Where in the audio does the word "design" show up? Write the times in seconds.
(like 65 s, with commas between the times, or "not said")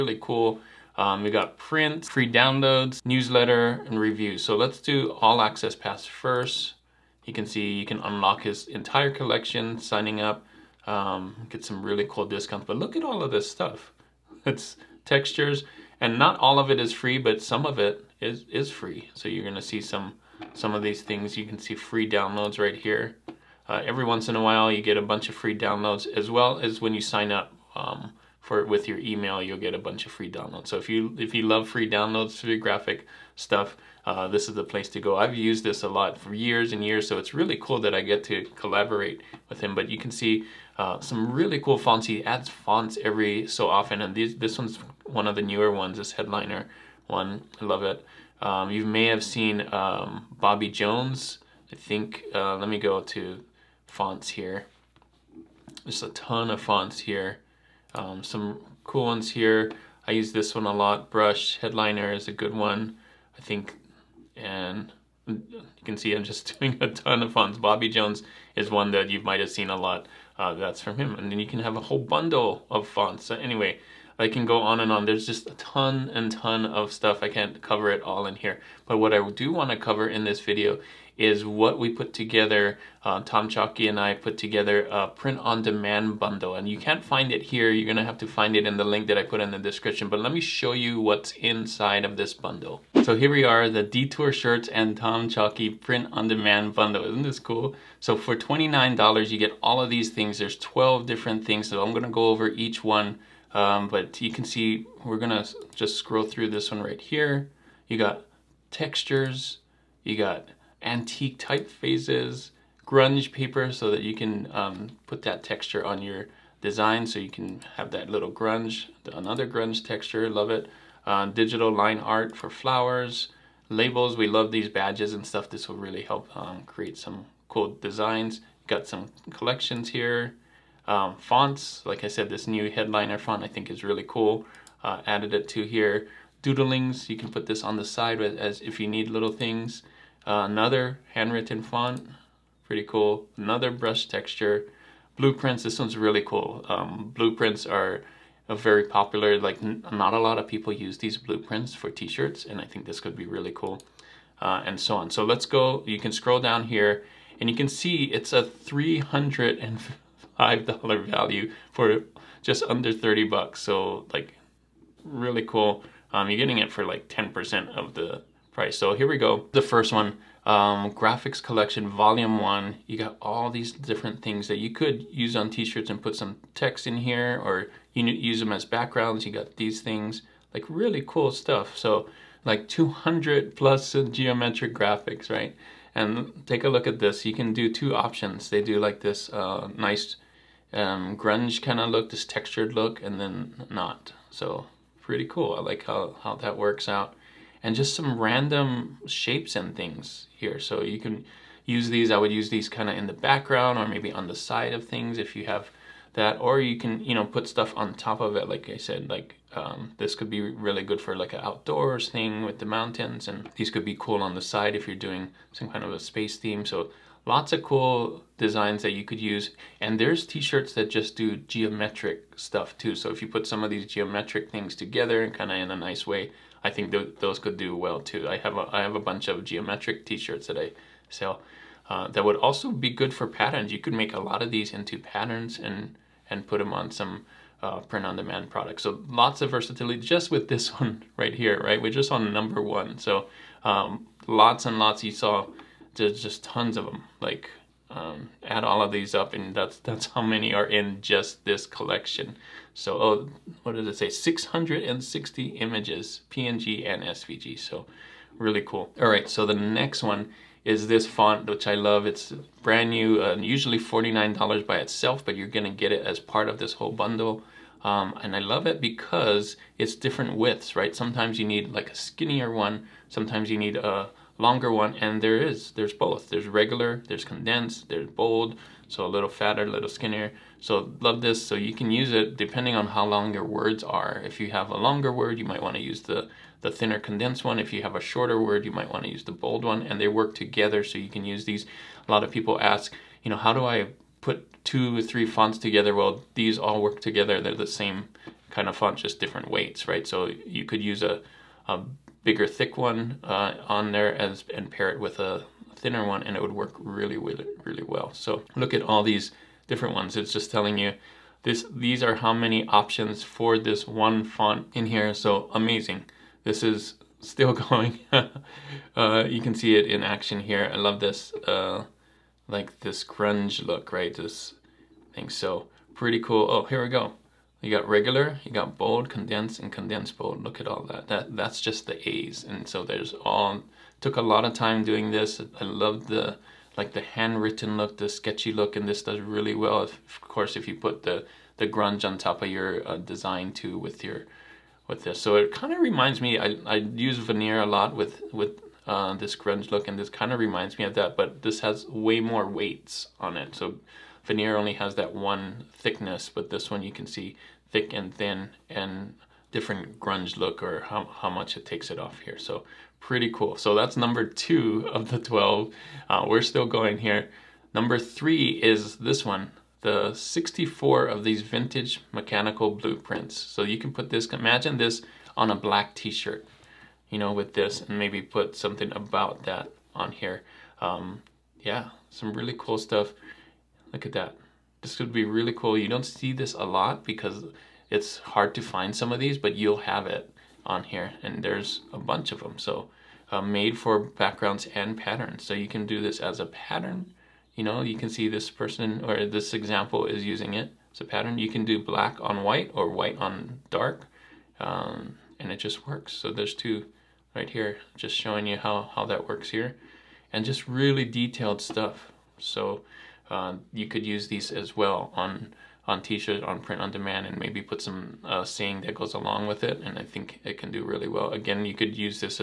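116 s, 127 s, 218 s, 342 s.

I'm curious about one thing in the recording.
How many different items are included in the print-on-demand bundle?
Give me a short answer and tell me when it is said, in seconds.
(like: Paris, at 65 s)
12, at 100 s.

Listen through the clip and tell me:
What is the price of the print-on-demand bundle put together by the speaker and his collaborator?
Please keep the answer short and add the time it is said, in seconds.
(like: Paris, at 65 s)
$29, at 98 s.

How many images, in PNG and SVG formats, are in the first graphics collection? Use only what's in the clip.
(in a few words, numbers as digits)
660.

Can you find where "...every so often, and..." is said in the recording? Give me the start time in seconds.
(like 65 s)
43 s.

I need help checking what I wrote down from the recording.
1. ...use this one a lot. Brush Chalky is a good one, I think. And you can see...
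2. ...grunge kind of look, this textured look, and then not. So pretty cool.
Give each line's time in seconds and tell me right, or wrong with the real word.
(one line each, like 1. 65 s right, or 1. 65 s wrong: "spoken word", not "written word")
1. 60 s wrong: "Headliner", not "Chalky"
2. 191 s right.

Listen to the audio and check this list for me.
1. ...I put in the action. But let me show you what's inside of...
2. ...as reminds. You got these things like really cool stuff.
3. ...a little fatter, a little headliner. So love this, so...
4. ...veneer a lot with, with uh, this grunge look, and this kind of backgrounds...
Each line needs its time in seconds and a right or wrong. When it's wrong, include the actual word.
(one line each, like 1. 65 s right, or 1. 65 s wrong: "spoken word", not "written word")
1. 89 s wrong: "description", not "action"
2. 178 s wrong: "backgrounds", not "reminds"
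3. 279 s wrong: "skinnier", not "headliner"
4. 347 s wrong: "reminds", not "backgrounds".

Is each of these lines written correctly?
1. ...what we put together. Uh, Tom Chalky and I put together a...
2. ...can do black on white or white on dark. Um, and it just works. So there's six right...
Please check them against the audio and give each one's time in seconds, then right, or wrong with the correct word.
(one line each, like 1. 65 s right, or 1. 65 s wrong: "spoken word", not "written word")
1. 81 s right
2. 401 s wrong: "two", not "six".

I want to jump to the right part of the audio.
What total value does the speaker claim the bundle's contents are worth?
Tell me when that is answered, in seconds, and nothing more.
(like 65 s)
158 s.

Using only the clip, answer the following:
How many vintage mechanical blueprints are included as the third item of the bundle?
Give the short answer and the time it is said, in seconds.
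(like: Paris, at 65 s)
64, at 370 s.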